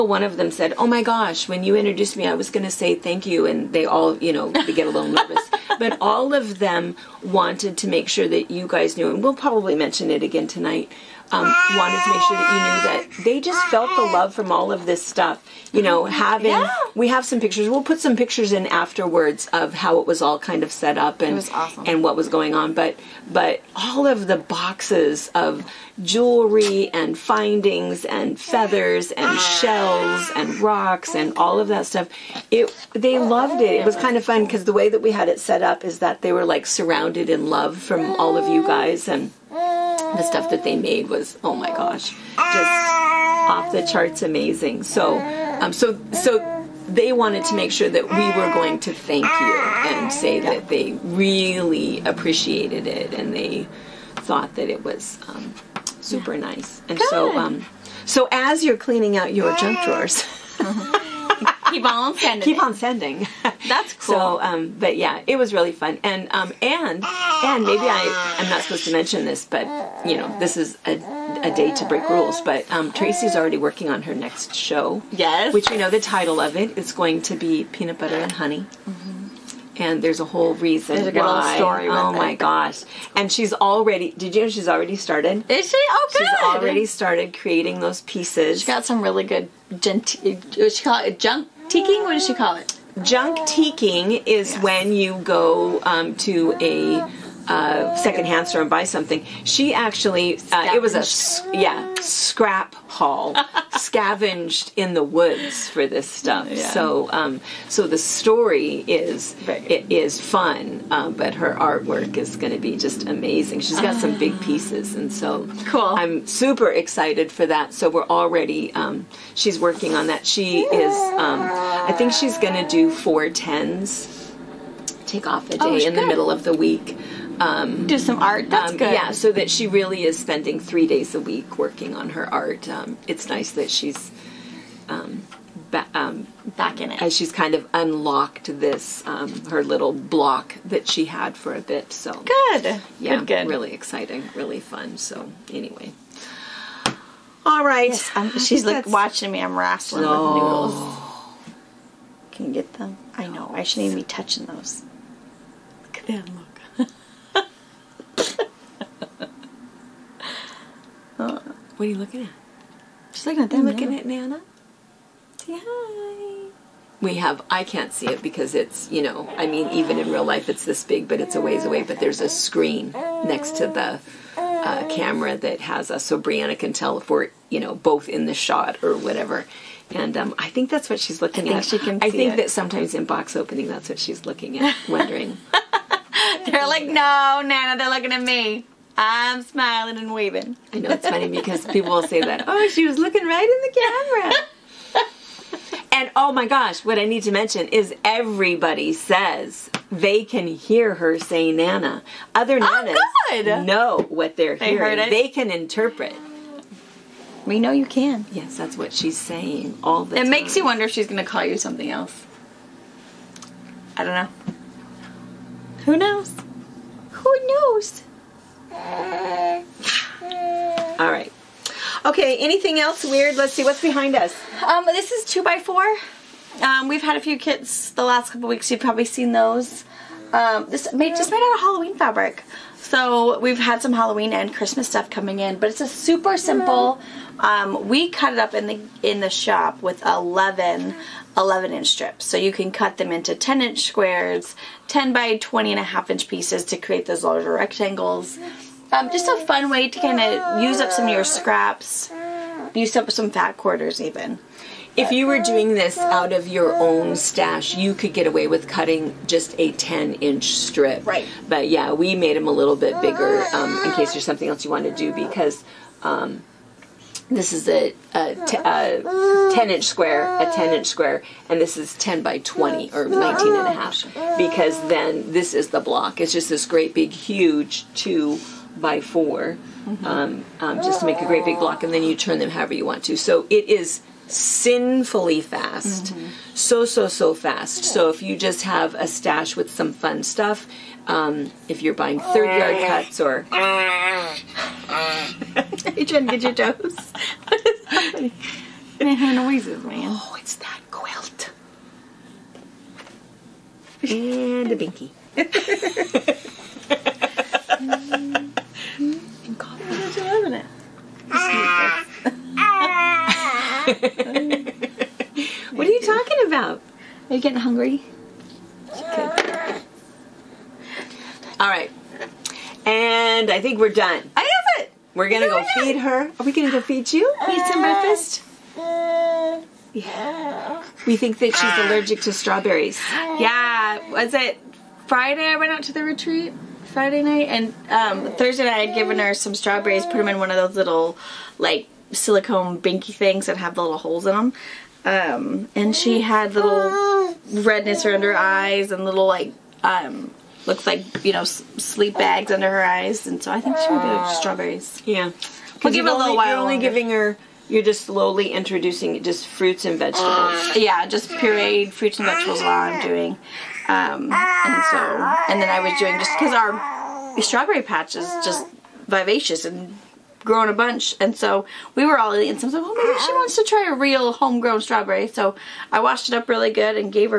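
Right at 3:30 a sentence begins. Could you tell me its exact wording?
It makes you wonder if she's going to call you something else.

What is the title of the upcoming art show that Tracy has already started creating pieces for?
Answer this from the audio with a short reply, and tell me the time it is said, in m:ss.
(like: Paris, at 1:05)
Peanut Butter and Honey, at 1:17.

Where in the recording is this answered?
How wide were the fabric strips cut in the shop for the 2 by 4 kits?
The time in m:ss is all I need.
4:00.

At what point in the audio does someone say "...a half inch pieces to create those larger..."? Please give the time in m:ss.
4:05.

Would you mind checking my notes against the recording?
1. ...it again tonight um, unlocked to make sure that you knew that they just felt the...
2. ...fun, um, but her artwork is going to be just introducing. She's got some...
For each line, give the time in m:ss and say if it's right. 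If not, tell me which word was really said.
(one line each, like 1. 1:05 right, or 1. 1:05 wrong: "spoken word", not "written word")
1. 0:10 wrong: "wanted", not "unlocked"
2. 1:50 wrong: "amazing", not "introducing".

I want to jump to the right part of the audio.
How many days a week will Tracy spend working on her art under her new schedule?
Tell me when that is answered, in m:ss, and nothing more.
2:10.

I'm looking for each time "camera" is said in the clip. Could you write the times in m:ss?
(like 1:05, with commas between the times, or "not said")
2:54, 3:15.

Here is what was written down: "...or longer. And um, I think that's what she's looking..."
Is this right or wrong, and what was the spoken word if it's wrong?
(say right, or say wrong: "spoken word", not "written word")
wrong: "whatever", not "longer".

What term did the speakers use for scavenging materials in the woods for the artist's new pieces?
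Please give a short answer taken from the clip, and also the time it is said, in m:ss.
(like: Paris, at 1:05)
scrap haul, at 1:41.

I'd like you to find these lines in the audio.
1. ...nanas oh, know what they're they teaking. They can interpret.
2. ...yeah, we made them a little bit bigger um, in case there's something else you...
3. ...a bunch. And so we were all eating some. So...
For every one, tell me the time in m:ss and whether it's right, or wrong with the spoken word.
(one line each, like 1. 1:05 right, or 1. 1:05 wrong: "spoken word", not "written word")
1. 3:22 wrong: "hearing", not "teaking"
2. 4:21 right
3. 6:10 right.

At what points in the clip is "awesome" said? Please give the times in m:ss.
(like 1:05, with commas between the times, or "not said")
0:21.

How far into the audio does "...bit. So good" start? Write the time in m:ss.
2:21.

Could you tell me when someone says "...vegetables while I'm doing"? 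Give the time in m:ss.
6:02.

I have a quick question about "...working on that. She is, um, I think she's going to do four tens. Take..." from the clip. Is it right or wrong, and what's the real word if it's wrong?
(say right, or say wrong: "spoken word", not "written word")
right.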